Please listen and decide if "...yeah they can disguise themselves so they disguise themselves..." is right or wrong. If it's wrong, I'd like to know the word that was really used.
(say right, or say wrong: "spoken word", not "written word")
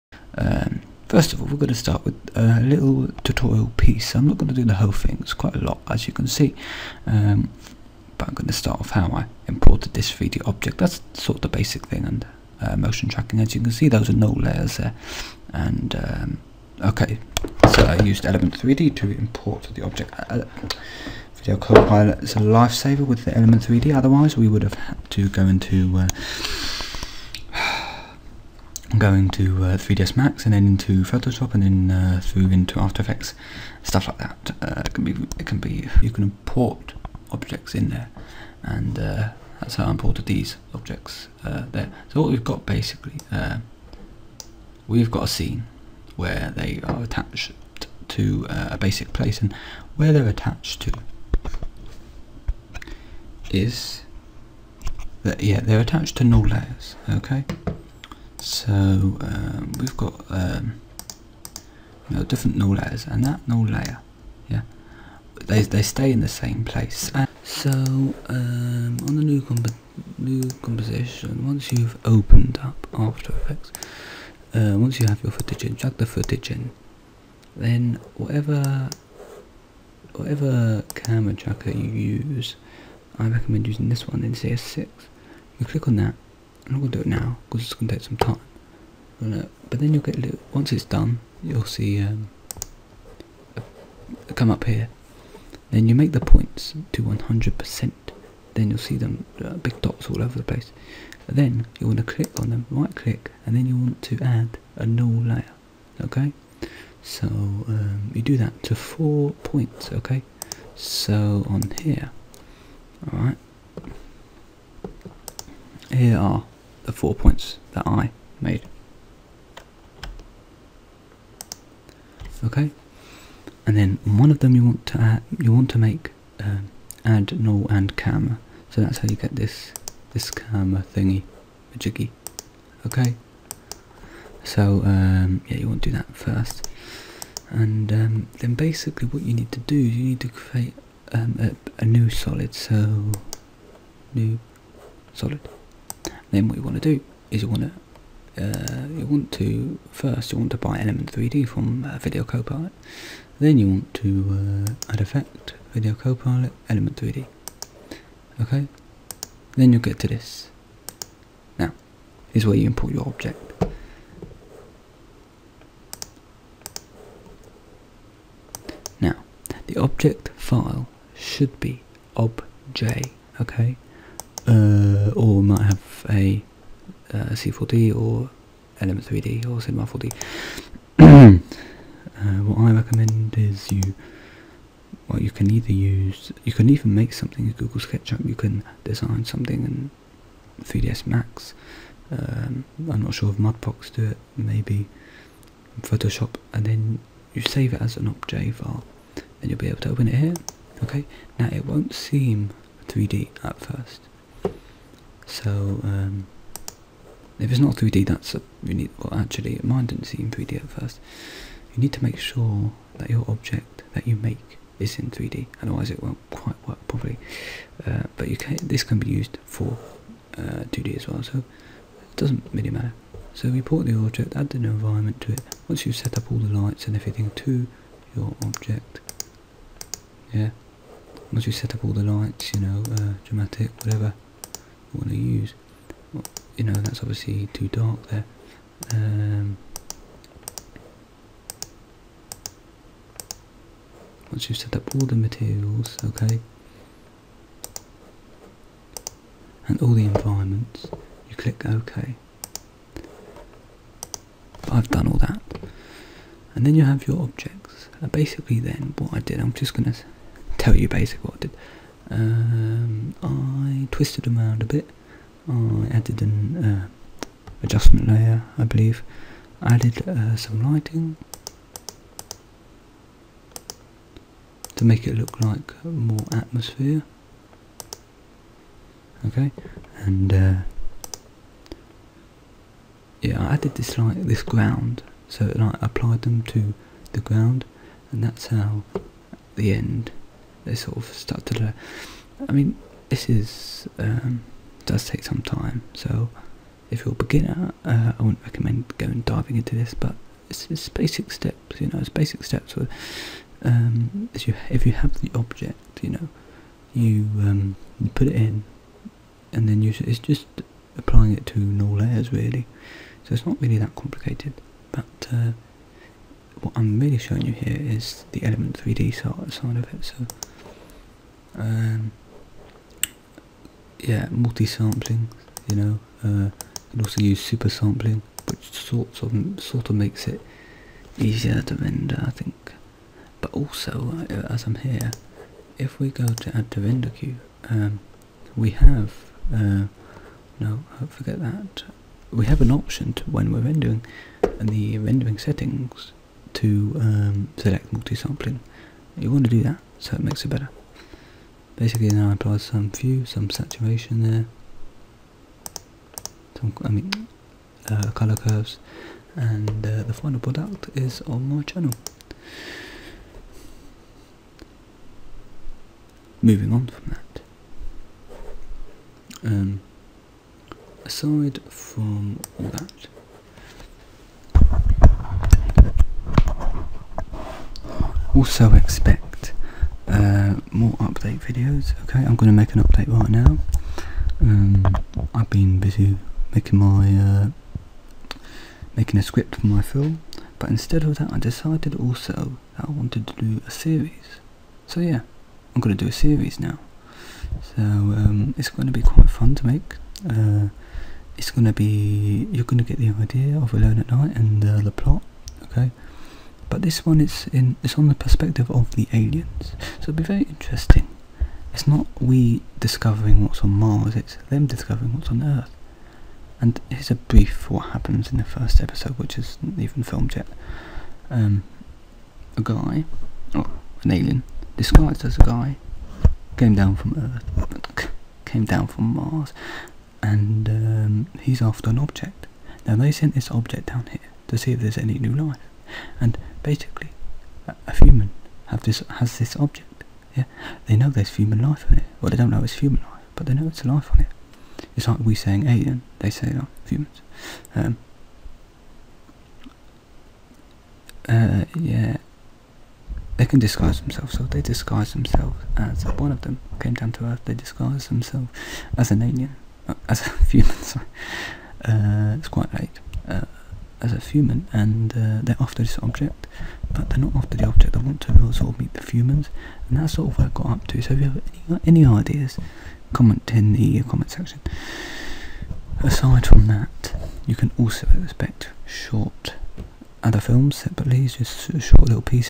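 right.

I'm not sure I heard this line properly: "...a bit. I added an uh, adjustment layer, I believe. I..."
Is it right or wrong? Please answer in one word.
right.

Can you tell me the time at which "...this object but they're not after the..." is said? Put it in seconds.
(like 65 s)
465 s.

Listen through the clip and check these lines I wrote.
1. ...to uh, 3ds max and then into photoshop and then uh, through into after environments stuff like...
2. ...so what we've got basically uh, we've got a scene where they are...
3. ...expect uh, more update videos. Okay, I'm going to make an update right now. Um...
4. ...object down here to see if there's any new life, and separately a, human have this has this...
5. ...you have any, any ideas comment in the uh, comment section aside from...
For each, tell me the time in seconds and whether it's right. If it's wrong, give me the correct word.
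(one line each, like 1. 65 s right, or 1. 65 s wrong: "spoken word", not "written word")
1. 29 s wrong: "effects", not "environments"
2. 42 s right
3. 378 s right
4. 433 s wrong: "basically", not "separately"
5. 471 s right.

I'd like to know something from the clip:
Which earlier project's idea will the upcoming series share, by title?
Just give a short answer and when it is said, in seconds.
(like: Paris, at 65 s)
Alone at Night, at 403 s.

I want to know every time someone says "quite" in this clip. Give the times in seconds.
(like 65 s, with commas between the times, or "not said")
5 s, 216 s, 399 s, 462 s.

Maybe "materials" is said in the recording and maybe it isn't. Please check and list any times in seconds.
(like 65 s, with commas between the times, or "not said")
245 s.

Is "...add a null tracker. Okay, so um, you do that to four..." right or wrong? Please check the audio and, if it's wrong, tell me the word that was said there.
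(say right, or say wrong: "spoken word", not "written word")
wrong: "layer", not "tracker".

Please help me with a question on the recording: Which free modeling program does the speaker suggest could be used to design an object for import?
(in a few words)
Google SketchUp.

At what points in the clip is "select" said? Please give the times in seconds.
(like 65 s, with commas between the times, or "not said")
347 s.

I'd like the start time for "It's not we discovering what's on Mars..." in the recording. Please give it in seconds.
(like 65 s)
411 s.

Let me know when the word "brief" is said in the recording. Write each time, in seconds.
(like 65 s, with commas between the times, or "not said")
417 s.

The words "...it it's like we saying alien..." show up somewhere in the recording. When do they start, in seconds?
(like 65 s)
444 s.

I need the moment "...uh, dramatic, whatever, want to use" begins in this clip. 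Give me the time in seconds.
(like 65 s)
232 s.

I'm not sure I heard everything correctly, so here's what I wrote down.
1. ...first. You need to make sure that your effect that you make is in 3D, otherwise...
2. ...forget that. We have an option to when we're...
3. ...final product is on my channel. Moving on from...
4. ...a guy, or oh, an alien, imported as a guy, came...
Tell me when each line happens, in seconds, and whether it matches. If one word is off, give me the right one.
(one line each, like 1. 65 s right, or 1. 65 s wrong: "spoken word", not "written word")
1. 210 s wrong: "object", not "effect"
2. 341 s right
3. 360 s right
4. 422 s wrong: "disguised", not "imported".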